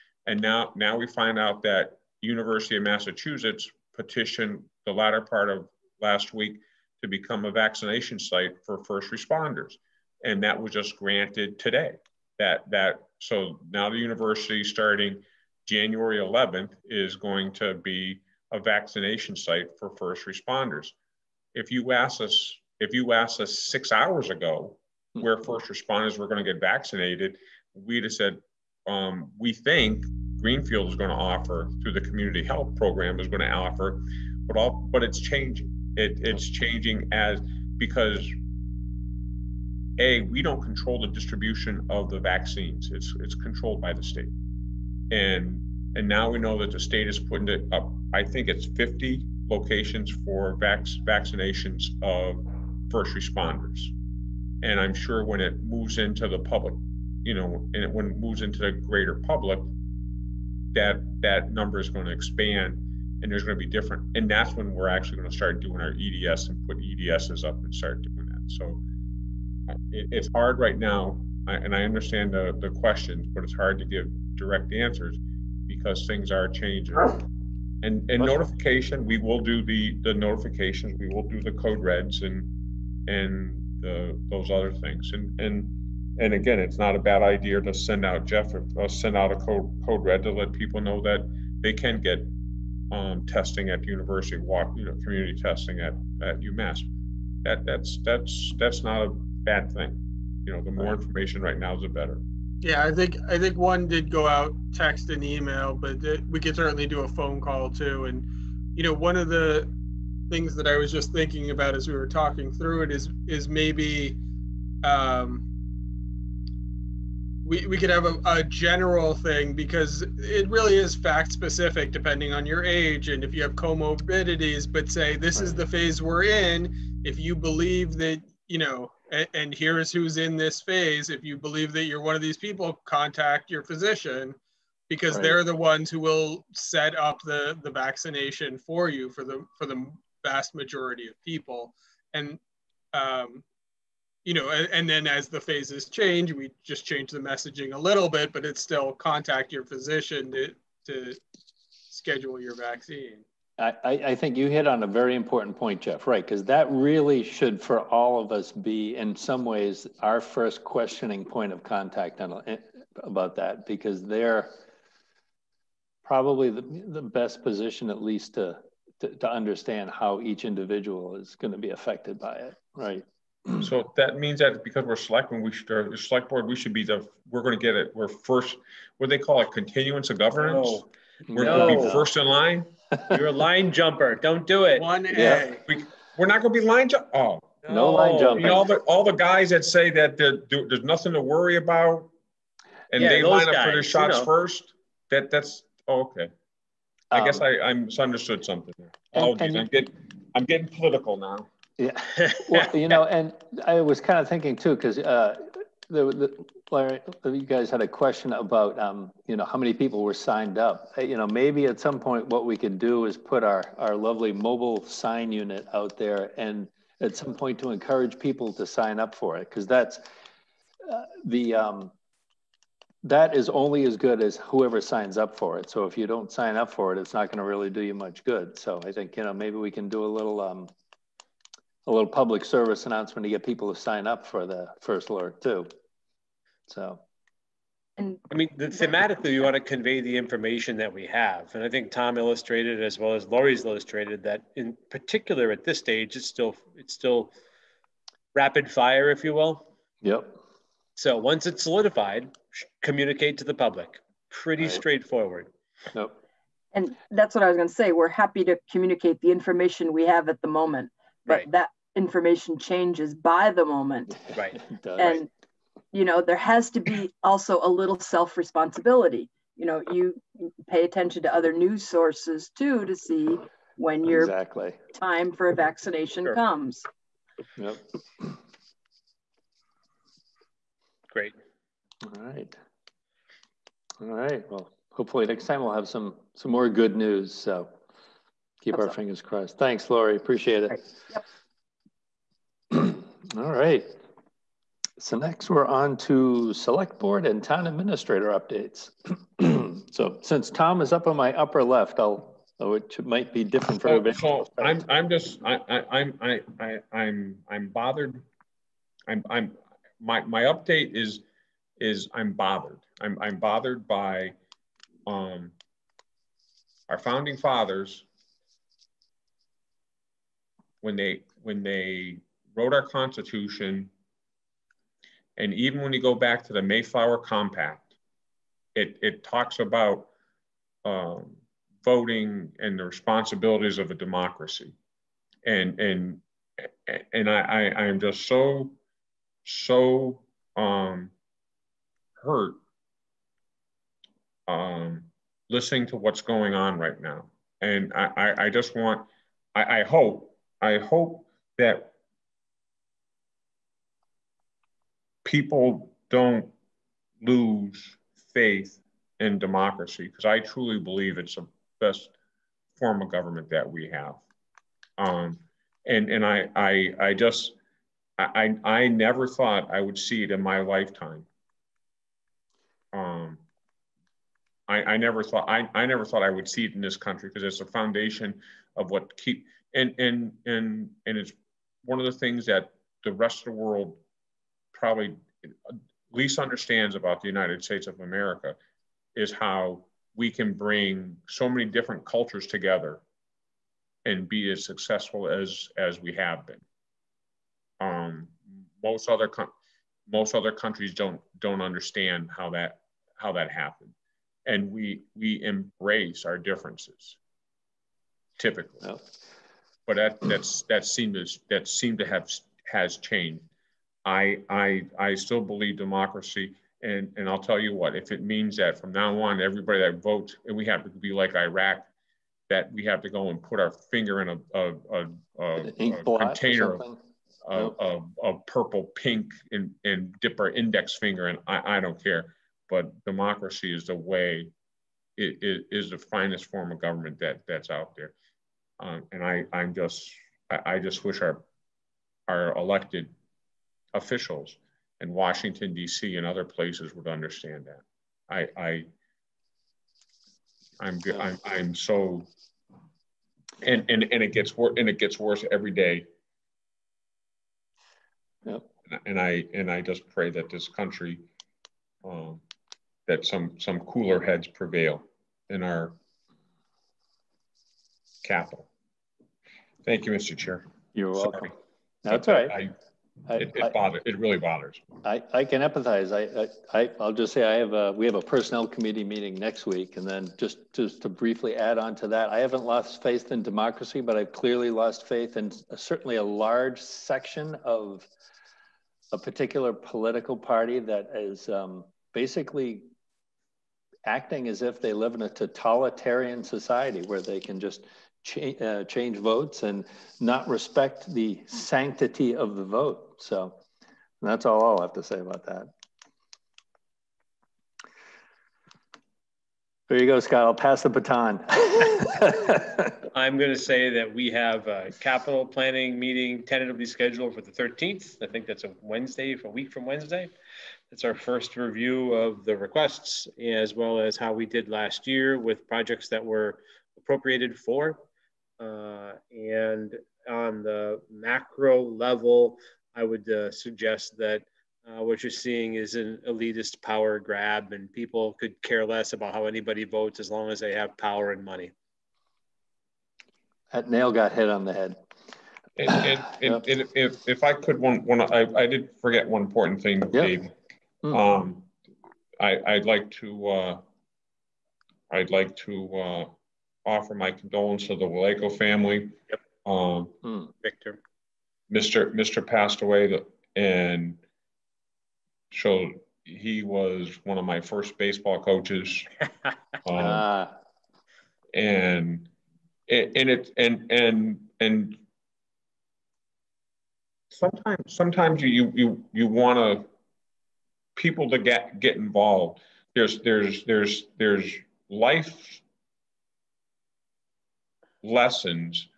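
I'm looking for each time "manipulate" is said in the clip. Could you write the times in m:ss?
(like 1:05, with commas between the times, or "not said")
not said.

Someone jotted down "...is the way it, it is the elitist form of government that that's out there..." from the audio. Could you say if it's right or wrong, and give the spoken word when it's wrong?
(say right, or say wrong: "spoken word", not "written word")
wrong: "finest", not "elitist".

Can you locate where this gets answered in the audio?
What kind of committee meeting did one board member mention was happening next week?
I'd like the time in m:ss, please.
7:58.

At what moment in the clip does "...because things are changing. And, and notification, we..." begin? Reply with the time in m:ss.
1:15.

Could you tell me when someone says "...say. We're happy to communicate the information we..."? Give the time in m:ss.
4:17.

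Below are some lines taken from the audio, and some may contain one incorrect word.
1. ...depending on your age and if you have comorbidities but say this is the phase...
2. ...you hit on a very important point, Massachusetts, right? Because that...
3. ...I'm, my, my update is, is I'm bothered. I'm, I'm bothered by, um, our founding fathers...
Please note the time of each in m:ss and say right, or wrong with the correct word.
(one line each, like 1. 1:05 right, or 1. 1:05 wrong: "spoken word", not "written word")
1. 2:01 right
2. 2:34 wrong: "Jeff", not "Massachusetts"
3. 5:09 right.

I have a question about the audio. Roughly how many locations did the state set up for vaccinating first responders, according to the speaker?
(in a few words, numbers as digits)
50.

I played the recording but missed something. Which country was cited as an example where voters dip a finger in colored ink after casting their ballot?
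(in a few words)
Iraq.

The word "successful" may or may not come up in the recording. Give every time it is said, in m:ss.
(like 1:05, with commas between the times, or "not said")
6:34.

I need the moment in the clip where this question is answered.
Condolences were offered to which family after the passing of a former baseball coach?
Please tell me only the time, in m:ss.
9:18.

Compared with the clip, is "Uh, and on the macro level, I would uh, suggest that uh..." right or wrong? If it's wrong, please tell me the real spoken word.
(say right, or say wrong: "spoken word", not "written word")
right.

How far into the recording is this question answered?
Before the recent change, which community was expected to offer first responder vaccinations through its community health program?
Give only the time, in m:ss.
0:30.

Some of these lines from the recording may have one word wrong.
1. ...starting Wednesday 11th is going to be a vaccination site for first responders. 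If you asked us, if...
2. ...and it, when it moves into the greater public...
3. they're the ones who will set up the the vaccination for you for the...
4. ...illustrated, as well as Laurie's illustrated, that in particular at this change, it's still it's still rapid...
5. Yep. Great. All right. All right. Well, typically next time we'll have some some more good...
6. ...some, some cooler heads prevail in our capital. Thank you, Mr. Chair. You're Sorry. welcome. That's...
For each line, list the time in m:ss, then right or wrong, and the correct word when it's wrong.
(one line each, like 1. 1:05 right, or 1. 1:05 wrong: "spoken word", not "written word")
1. 0:14 wrong: "January", not "Wednesday"
2. 0:57 right
3. 2:15 right
4. 4:02 wrong: "stage", not "change"
5. 4:37 wrong: "hopefully", not "typically"
6. 7:43 right.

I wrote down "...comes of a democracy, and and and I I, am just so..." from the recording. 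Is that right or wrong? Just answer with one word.
wrong.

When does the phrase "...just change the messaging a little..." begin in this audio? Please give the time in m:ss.
2:26.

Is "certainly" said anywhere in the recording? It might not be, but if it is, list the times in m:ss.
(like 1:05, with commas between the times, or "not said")
1:46, 8:05.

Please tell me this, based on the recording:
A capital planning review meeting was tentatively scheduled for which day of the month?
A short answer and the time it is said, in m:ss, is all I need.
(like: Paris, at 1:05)
13th, at 8:37.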